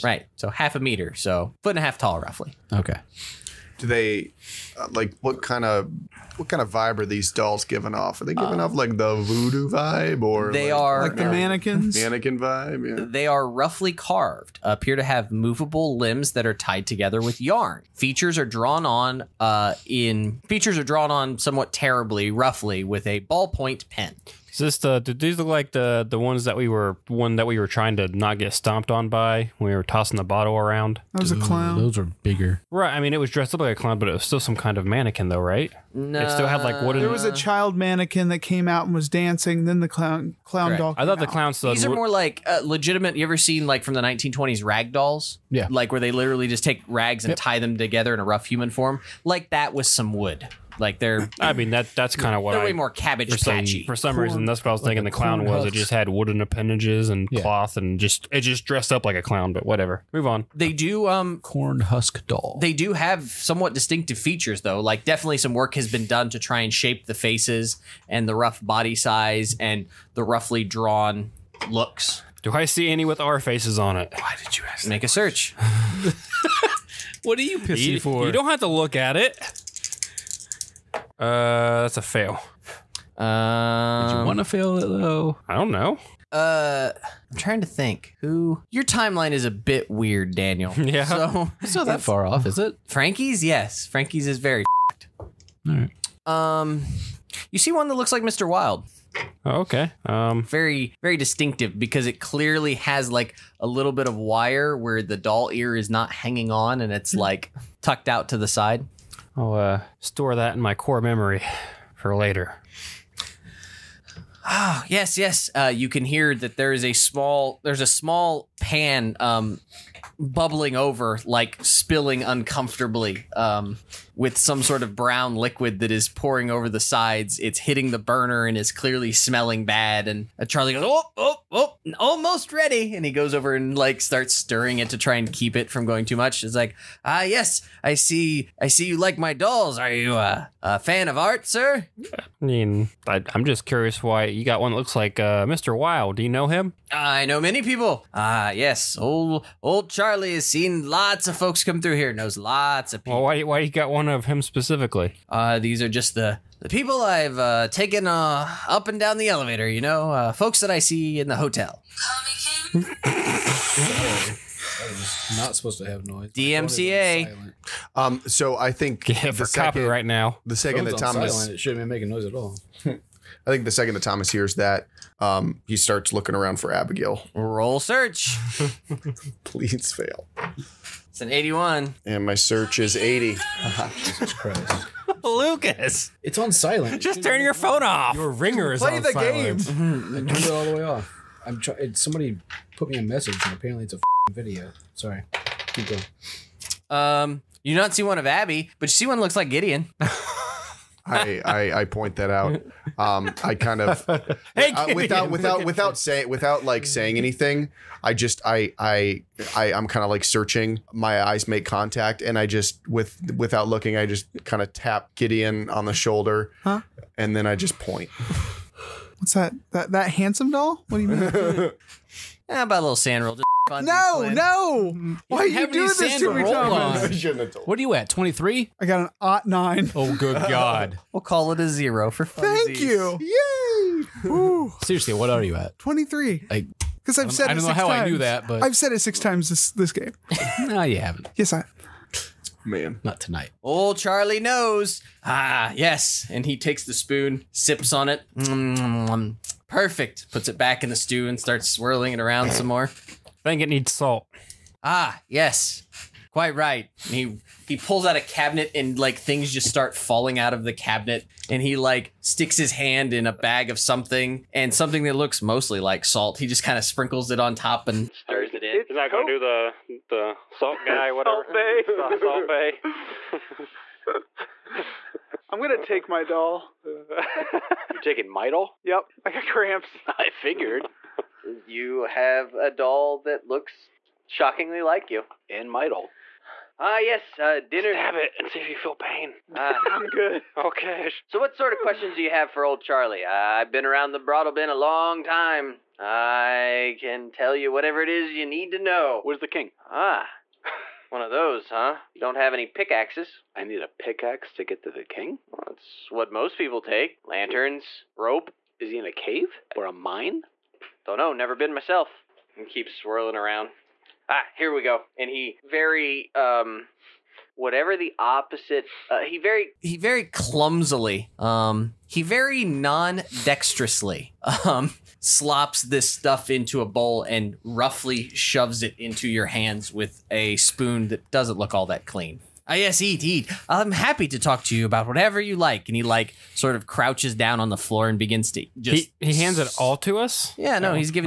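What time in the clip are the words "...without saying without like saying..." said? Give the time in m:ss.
3:25.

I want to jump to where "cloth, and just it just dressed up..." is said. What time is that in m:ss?
0:57.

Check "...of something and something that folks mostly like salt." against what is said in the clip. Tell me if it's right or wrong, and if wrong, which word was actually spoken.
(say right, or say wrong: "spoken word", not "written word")
wrong: "looks", not "folks".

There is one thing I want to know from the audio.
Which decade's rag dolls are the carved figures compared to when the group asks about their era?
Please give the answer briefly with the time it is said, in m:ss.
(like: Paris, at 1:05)
1920s, at 0:44.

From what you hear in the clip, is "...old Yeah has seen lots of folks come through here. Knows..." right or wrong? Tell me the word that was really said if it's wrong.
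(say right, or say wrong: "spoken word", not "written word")
wrong: "Charlie", not "Yeah".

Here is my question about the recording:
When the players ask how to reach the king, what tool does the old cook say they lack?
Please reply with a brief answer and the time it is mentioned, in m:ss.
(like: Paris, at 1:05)
pickaxes, at 5:02.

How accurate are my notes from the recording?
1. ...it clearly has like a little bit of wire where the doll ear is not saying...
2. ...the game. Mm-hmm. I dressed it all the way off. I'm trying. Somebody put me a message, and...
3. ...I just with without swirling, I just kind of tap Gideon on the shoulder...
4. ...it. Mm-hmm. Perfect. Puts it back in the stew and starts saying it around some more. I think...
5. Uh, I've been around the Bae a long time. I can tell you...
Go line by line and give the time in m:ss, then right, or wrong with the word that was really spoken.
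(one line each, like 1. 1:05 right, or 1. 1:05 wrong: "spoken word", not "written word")
1. 1:42 wrong: "hanging", not "saying"
2. 3:08 wrong: "turned", not "dressed"
3. 3:32 wrong: "looking", not "swirling"
4. 4:08 wrong: "swirling", not "saying"
5. 4:53 wrong: "Broadalbin", not "Bae".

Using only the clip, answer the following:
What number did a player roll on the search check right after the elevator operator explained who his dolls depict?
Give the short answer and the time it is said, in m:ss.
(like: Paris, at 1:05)
81, at 3:01.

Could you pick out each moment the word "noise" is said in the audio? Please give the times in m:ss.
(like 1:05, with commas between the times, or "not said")
2:46, 2:52.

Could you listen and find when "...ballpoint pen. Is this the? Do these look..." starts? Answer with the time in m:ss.
0:23.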